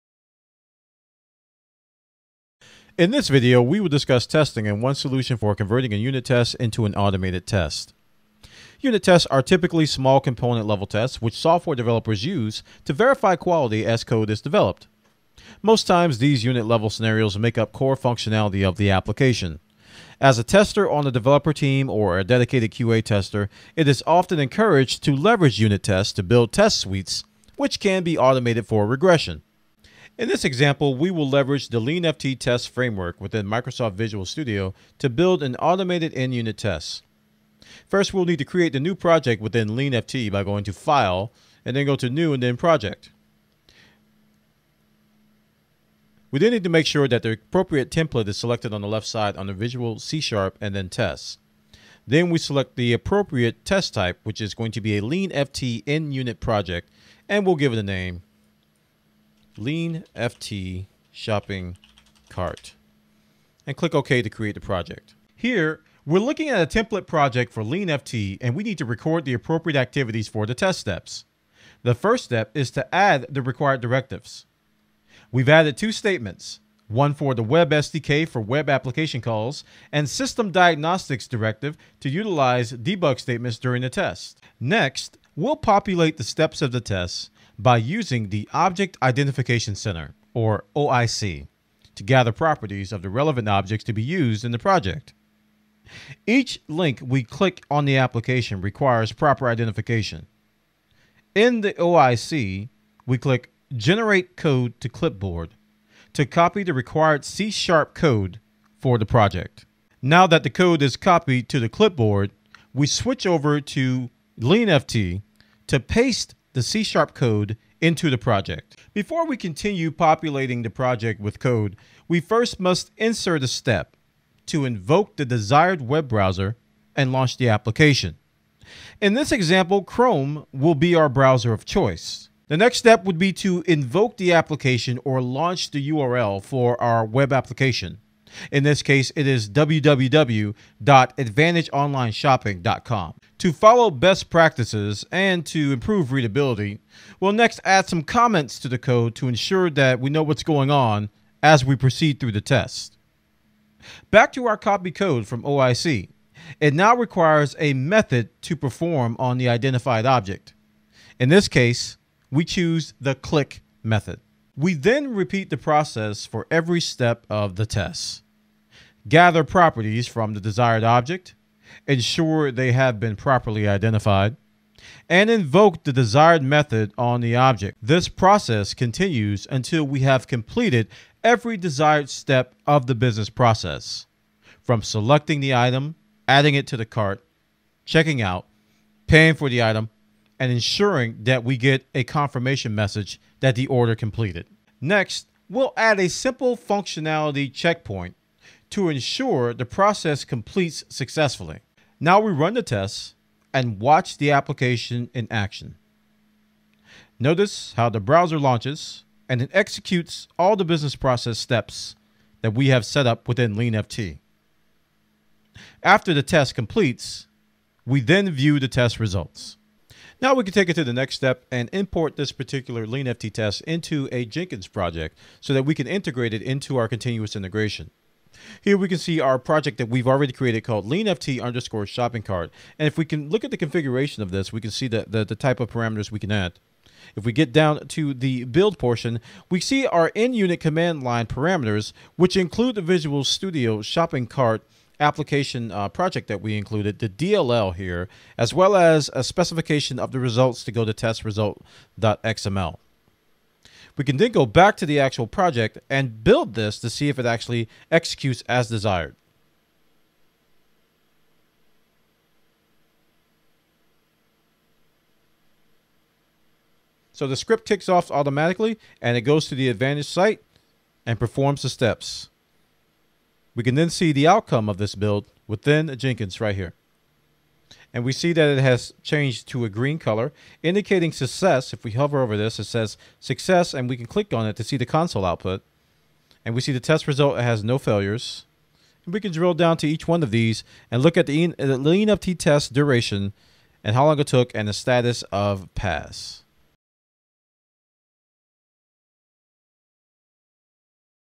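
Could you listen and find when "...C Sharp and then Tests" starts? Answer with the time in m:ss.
0:49.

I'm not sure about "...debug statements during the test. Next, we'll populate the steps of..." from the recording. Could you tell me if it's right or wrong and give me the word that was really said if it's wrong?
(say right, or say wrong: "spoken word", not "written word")
right.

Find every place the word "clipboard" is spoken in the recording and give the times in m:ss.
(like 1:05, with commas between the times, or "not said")
1:44, 1:51.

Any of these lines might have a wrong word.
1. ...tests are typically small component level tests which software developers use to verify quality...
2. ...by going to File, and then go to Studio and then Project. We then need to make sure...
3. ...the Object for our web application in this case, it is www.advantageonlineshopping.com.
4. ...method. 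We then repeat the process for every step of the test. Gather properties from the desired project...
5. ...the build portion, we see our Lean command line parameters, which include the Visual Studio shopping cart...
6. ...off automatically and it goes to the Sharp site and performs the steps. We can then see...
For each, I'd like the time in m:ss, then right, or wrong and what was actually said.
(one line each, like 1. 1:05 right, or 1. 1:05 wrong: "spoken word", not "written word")
1. 0:09 right
2. 0:40 wrong: "New", not "Studio"
3. 2:15 wrong: "URL", not "Object"
4. 2:43 wrong: "object", not "project"
5. 3:58 wrong: "NUnit", not "Lean"
6. 4:27 wrong: "Advantage", not "Sharp".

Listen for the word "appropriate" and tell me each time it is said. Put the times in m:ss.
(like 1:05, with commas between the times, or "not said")
0:47, 0:52, 1:09.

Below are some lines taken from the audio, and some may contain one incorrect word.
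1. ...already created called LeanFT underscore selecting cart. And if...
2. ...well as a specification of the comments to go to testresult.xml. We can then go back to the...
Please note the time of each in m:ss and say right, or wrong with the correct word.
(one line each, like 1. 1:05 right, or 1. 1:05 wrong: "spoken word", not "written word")
1. 3:50 wrong: "shopping", not "selecting"
2. 4:08 wrong: "results", not "comments".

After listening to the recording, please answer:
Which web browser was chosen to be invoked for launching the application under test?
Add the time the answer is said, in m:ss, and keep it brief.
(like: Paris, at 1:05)
Chrome, at 2:09.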